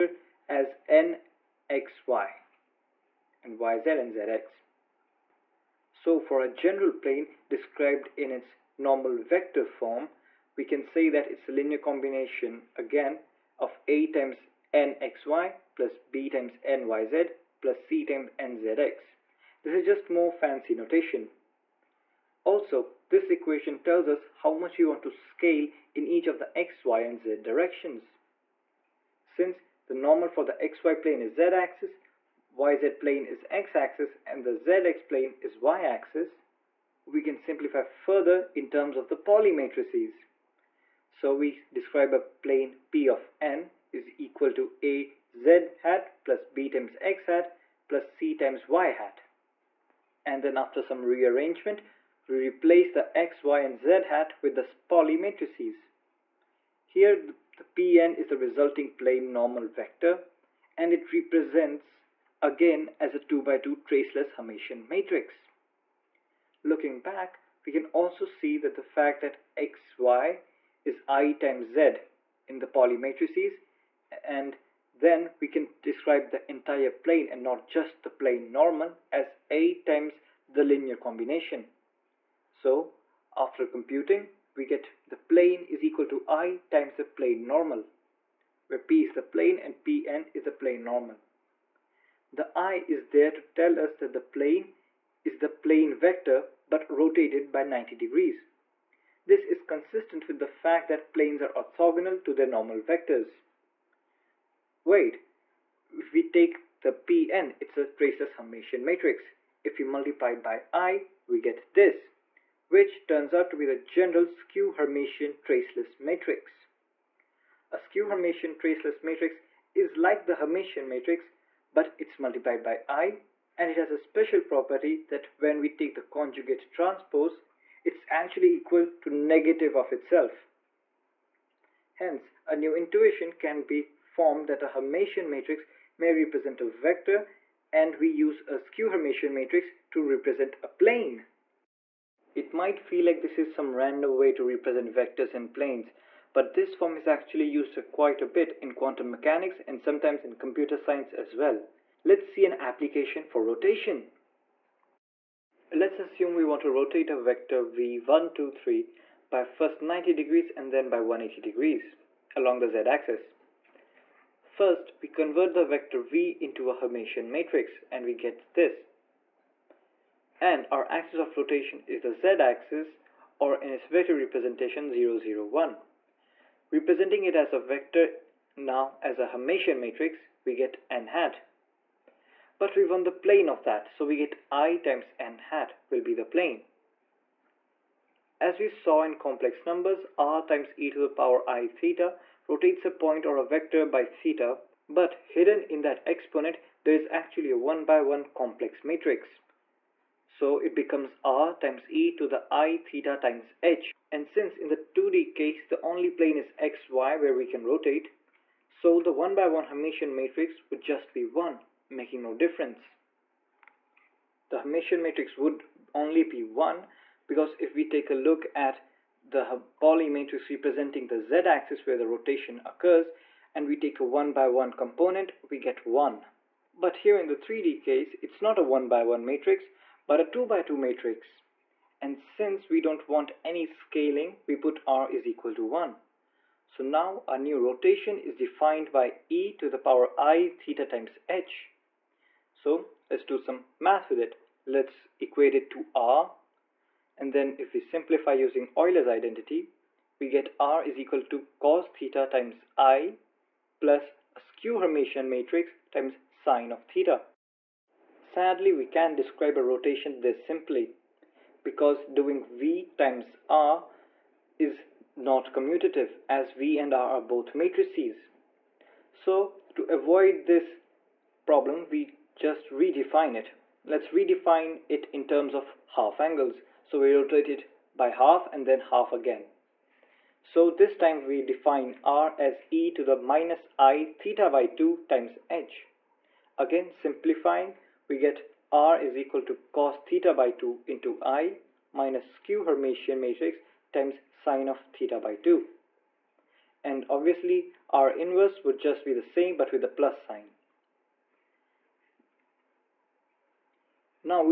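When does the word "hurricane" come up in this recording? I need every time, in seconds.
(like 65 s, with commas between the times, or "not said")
not said.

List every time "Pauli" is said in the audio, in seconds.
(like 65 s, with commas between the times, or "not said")
39 s, 54 s, 72 s, 219 s.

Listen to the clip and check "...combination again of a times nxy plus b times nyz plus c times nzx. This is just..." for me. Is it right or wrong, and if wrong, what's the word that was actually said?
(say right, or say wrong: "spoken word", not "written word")
right.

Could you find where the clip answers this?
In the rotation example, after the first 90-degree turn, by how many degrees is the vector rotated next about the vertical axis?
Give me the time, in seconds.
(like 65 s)
160 s.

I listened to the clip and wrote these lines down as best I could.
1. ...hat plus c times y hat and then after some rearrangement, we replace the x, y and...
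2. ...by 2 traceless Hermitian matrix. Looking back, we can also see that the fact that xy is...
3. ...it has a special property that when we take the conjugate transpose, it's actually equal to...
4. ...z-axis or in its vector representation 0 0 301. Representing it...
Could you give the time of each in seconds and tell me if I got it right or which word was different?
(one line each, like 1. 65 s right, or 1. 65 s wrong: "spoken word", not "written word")
1. 47 s right
2. 63 s right
3. 123 s right
4. 172 s wrong: "001", not "301".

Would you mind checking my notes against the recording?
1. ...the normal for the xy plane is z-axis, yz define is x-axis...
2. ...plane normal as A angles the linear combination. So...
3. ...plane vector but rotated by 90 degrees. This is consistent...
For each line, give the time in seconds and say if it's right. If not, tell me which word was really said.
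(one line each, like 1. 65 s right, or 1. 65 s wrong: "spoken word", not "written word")
1. 29 s wrong: "plane", not "define"
2. 78 s wrong: "times", not "angles"
3. 95 s right.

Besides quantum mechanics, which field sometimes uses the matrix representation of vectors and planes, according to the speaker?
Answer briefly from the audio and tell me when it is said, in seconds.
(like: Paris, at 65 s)
computer science, at 150 s.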